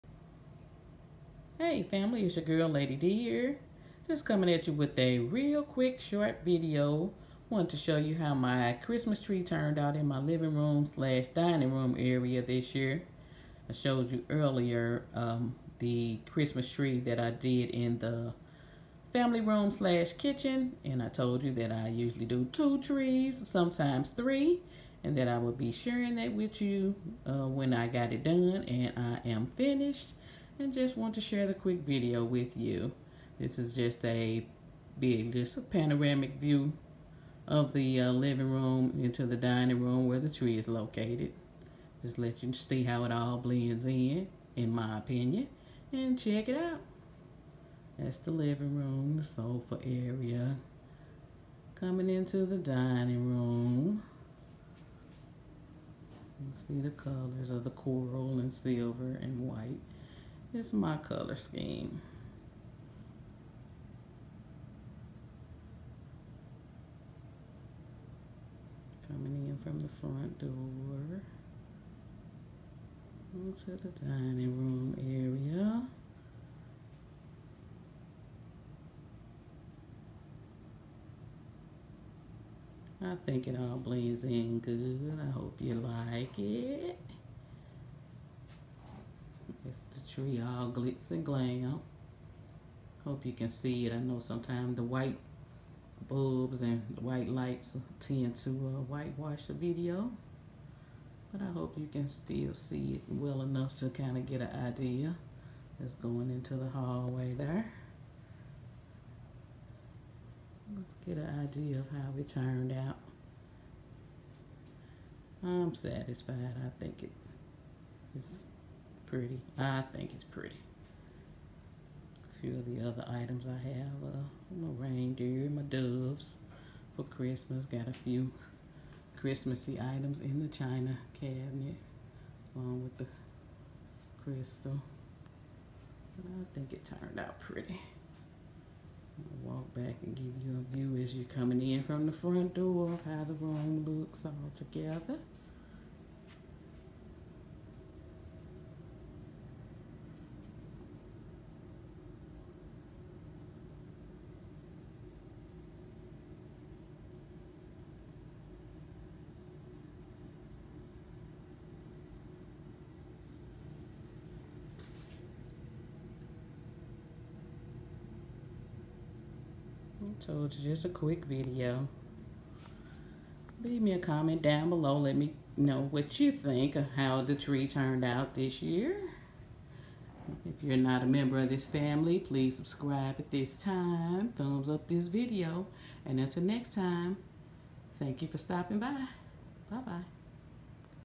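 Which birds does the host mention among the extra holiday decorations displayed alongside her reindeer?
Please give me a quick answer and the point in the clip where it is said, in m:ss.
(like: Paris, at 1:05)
doves, at 2:05.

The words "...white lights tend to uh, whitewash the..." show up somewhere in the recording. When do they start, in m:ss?
1:37.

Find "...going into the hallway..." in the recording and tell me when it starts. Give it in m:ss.
1:45.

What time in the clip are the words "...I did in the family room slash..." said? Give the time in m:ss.
0:17.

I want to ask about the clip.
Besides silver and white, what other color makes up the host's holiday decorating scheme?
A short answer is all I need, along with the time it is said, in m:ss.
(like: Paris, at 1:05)
coral, at 0:57.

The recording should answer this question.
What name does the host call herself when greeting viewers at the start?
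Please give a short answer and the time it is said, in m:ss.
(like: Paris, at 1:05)
Lady D, at 0:02.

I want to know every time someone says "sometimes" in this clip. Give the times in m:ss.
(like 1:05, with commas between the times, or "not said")
0:23, 1:34.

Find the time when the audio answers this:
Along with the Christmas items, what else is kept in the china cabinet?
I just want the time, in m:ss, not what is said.
2:14.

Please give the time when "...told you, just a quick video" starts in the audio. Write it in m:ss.
2:50.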